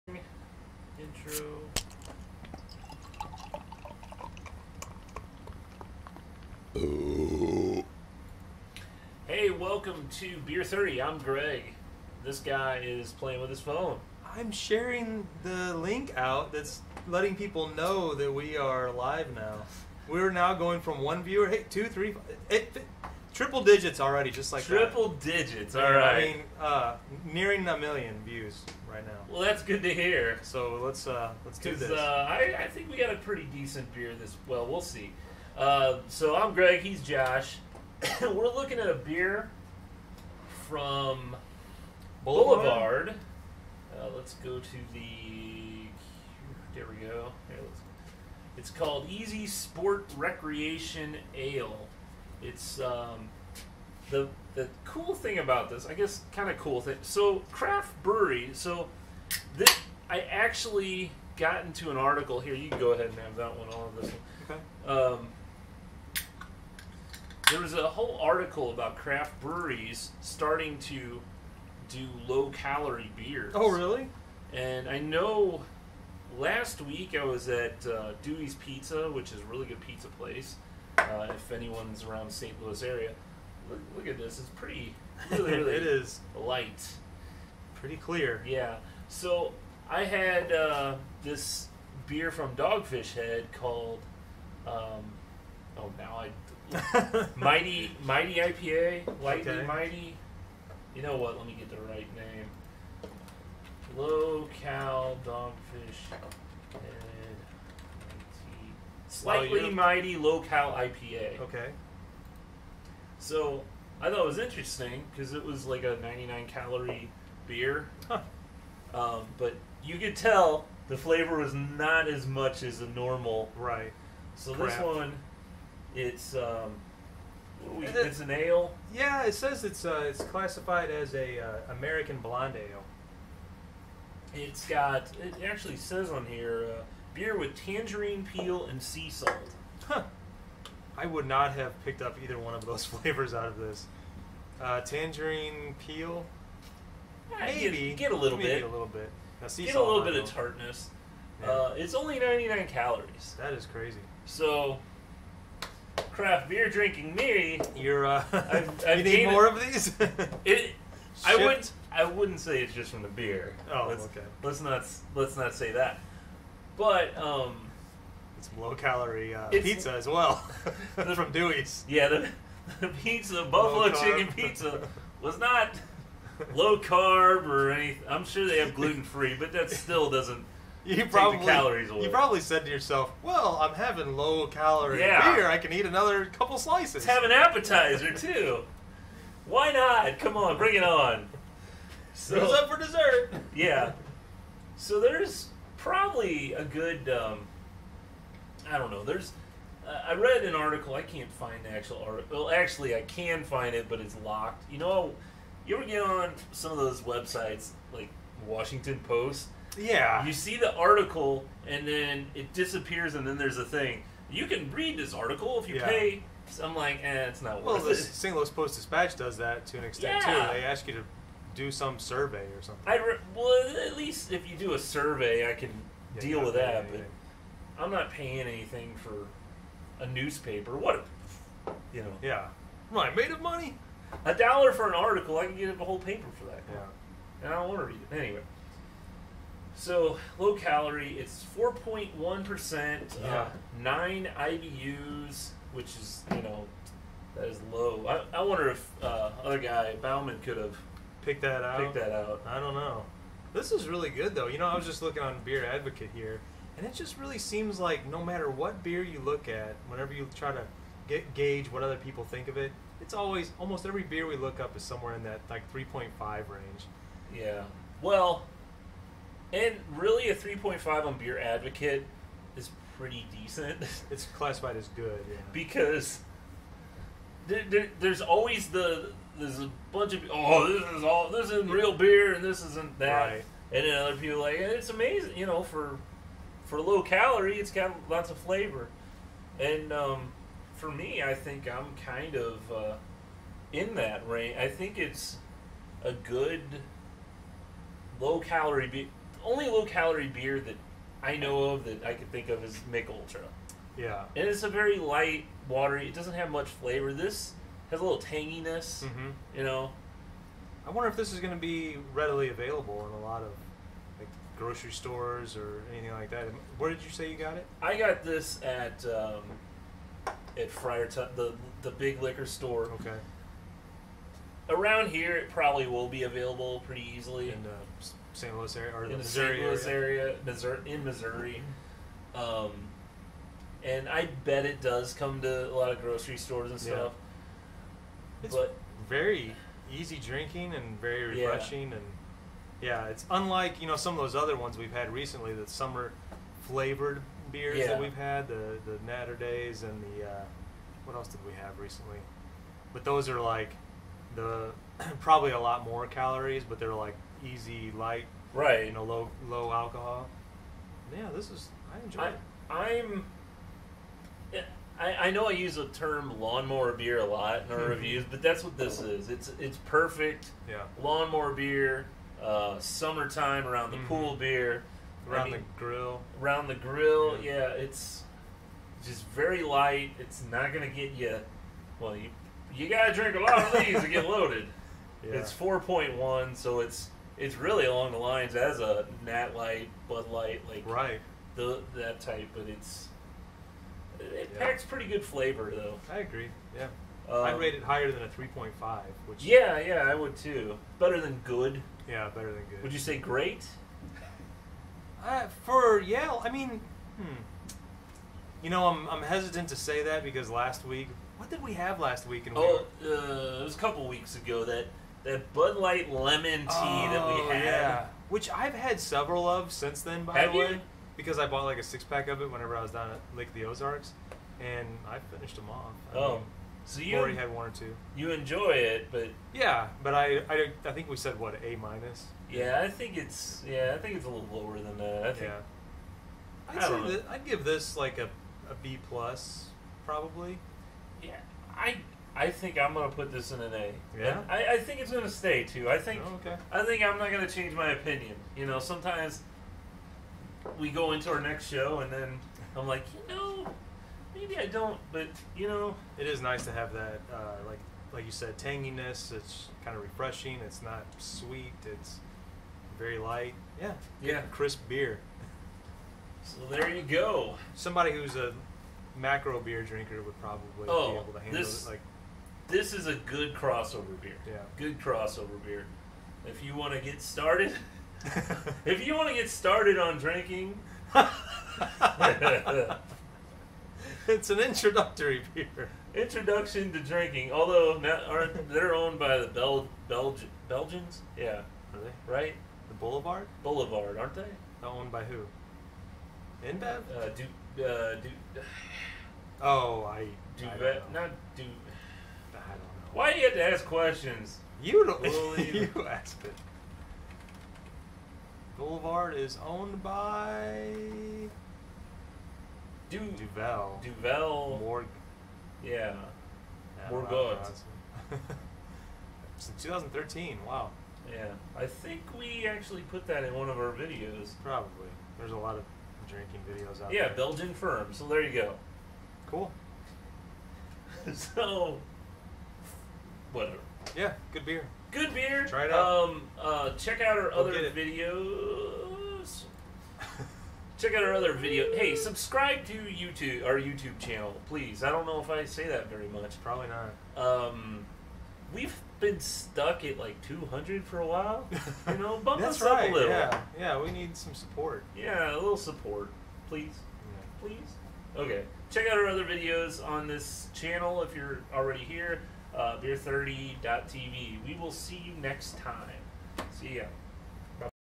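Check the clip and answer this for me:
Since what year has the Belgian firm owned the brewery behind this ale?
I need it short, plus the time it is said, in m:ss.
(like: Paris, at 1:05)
2013, at 8:39.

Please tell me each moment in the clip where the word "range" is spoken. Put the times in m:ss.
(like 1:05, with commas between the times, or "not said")
4:26, 4:54.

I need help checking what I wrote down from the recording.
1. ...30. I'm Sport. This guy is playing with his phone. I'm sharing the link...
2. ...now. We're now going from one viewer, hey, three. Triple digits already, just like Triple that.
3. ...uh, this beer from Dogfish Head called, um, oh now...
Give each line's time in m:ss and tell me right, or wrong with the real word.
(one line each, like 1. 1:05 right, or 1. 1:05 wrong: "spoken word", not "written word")
1. 0:10 wrong: "Greg", not "Sport"
2. 0:19 right
3. 1:30 right.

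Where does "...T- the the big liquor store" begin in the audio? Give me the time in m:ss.
5:21.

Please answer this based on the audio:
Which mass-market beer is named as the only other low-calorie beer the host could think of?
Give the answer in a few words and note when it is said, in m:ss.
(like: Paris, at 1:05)
Mich Ultra, at 5:02.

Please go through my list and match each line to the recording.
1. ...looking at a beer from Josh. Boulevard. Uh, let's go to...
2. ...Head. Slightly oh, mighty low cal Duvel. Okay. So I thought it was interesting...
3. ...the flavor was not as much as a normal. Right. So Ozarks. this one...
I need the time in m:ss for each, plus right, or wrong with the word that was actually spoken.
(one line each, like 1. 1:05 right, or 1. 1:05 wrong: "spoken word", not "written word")
1. 0:38 wrong: "Boulevard", not "Josh"
2. 1:46 wrong: "IPA", not "Duvel"
3. 2:00 wrong: "Crap", not "Ozarks".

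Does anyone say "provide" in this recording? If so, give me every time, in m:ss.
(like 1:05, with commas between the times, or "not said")
not said.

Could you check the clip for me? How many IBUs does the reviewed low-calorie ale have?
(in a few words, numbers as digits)
9.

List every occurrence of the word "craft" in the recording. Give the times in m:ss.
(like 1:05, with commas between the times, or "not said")
0:57, 1:08, 2:36.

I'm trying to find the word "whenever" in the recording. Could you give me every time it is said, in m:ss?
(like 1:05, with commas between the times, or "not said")
4:19, 7:02.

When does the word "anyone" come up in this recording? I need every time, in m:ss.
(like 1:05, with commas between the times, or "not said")
1:21.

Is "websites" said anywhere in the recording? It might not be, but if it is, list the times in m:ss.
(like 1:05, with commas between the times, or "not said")
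3:27.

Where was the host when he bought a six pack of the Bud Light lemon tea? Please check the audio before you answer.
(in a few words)
Lake of the Ozarks.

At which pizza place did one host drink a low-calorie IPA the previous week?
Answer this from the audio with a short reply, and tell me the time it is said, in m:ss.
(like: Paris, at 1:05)
Dewey's Pizza, at 1:18.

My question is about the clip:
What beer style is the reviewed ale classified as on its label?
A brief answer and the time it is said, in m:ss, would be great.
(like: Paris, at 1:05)
American blonde ale, at 2:11.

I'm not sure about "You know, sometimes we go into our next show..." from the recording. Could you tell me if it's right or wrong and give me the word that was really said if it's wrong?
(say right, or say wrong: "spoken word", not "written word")
right.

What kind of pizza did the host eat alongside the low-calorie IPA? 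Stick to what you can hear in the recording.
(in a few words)
buffalo chicken.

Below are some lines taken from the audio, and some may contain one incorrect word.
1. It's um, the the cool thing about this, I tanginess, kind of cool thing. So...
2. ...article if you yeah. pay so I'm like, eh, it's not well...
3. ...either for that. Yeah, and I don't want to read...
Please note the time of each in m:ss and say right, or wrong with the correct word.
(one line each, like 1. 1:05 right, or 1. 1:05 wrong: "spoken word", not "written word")
1. 0:52 wrong: "guess", not "tanginess"
2. 3:35 right
3. 3:55 wrong: "paper", not "either".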